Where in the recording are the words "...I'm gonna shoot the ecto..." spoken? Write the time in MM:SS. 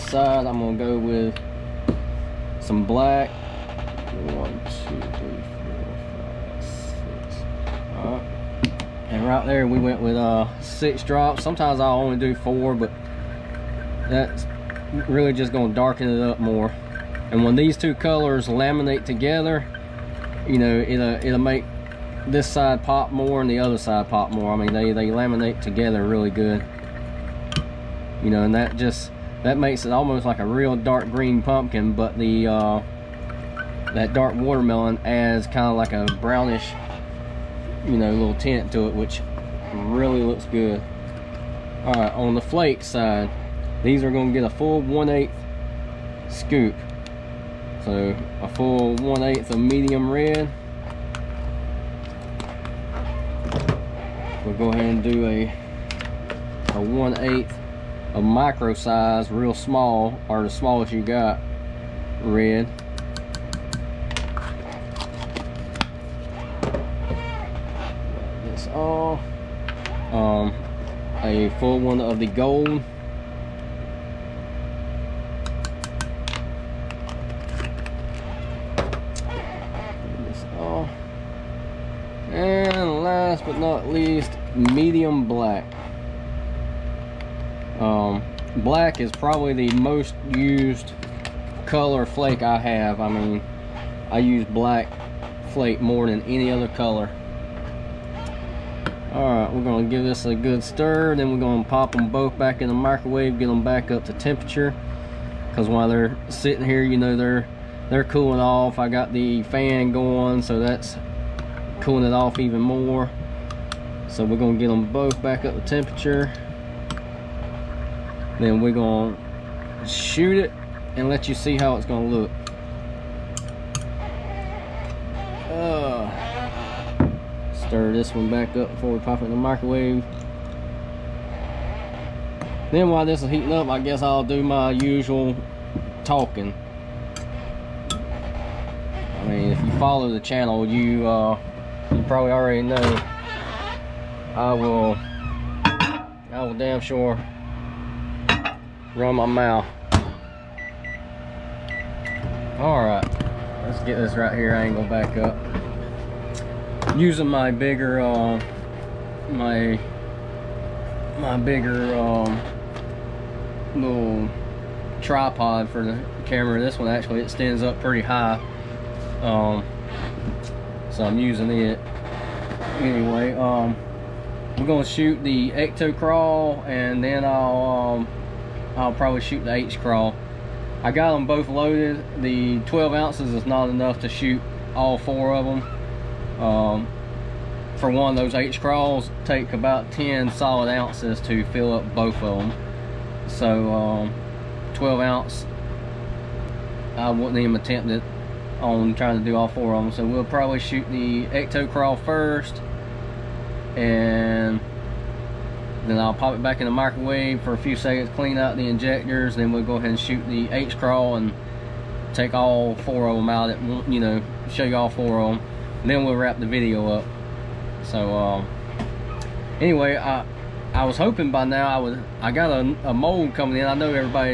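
02:54.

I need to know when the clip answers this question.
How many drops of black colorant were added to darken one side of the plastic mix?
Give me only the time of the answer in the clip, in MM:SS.
00:10.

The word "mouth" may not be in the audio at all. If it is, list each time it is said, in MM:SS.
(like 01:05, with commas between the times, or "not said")
02:29.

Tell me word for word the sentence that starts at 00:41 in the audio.
All right, on the flake side, these are gonna get a full 1 8 scoop.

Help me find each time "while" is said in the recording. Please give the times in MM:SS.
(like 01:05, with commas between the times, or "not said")
01:45, 02:12.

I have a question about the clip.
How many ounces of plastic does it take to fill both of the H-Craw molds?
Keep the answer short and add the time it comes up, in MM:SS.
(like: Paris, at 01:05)
10 ounces, at 03:09.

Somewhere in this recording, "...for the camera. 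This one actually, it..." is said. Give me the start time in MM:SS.
02:45.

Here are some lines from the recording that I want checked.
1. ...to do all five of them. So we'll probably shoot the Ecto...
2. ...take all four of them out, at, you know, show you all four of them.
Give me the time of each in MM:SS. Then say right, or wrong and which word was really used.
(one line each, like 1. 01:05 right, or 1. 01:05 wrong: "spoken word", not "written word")
1. 03:19 wrong: "four", not "five"
2. 03:32 right.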